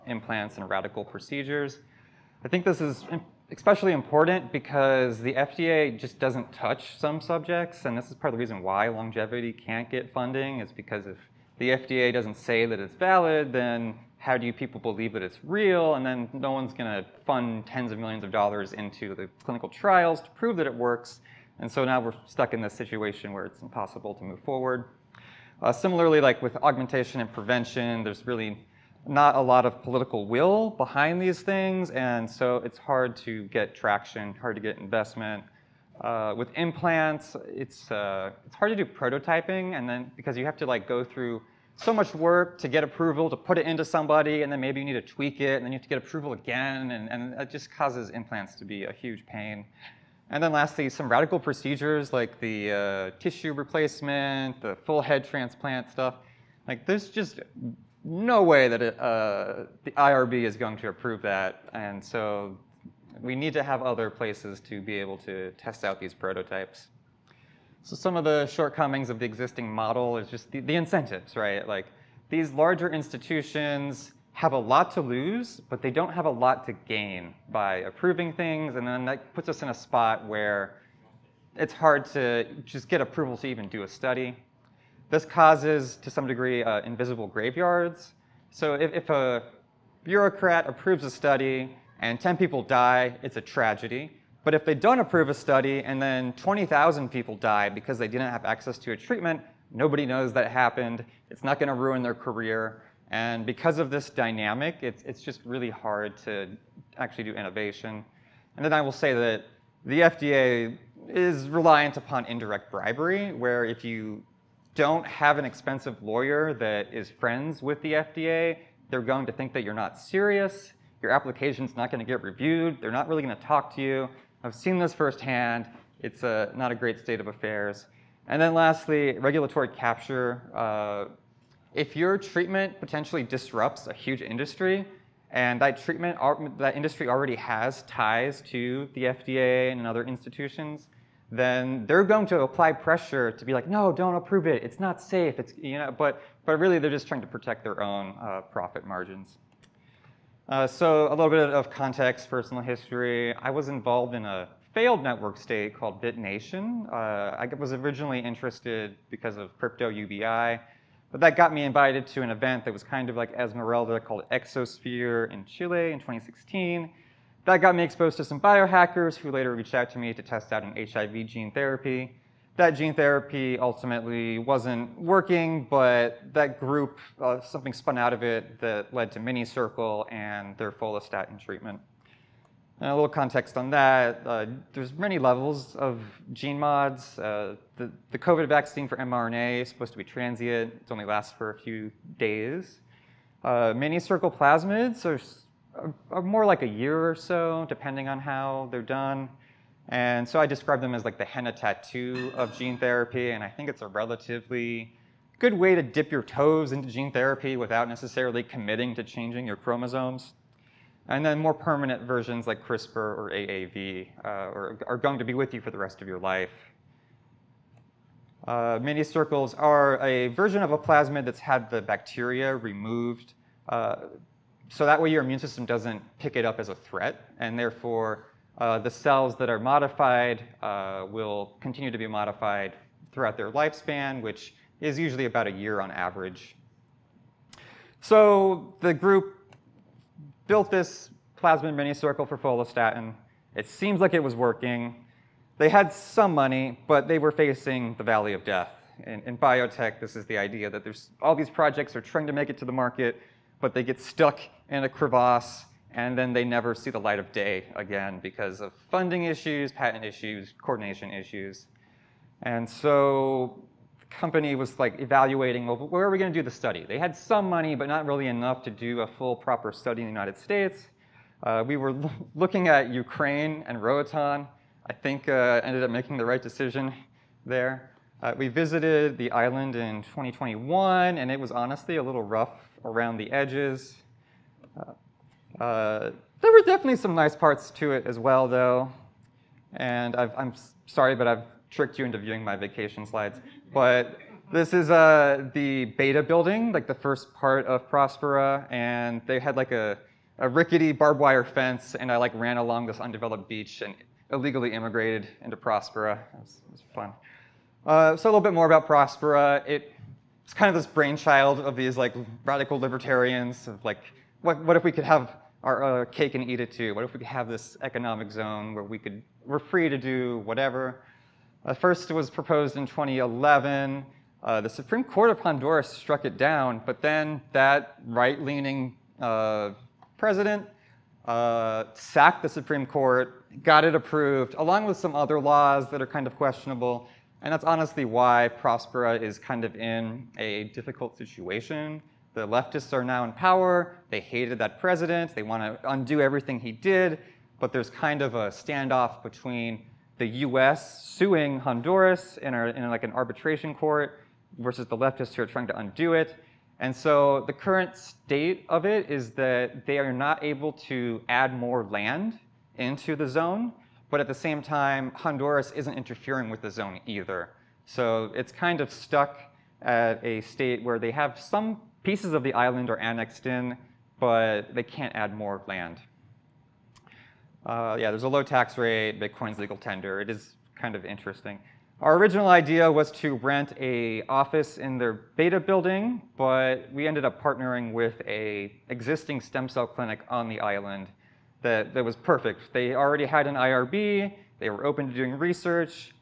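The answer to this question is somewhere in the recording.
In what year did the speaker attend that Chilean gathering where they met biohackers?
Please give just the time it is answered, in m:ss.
2:45.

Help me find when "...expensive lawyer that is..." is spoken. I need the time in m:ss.
1:55.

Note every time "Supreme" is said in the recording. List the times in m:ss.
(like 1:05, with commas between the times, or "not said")
5:24, 5:32.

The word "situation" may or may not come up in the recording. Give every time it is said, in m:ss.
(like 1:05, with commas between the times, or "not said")
0:22, 5:41.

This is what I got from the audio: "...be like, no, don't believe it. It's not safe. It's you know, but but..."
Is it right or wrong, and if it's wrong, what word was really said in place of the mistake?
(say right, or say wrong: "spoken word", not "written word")
wrong: "approve", not "believe".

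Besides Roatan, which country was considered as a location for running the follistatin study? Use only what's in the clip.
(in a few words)
Ukraine.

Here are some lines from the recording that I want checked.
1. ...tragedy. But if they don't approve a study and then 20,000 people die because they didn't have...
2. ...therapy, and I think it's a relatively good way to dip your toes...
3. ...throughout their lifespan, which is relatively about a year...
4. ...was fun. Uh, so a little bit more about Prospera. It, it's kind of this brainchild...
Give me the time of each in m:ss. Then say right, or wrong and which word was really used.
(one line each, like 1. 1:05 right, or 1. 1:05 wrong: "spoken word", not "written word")
1. 1:33 right
2. 3:22 right
3. 3:53 wrong: "usually", not "relatively"
4. 5:06 right.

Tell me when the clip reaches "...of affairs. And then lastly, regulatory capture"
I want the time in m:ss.
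2:07.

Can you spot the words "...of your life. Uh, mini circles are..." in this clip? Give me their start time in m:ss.
3:36.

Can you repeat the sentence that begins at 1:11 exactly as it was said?
Like these larger institutions have a lot to lose, but they don't have a lot to gain by approving things.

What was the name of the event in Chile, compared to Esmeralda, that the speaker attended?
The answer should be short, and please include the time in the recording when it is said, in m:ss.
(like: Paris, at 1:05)
Exosphere, at 2:44.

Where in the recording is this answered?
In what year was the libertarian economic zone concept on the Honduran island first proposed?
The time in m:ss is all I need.
5:22.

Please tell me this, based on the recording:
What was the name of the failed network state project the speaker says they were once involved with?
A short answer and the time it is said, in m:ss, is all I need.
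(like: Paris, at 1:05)
BitNation, at 2:36.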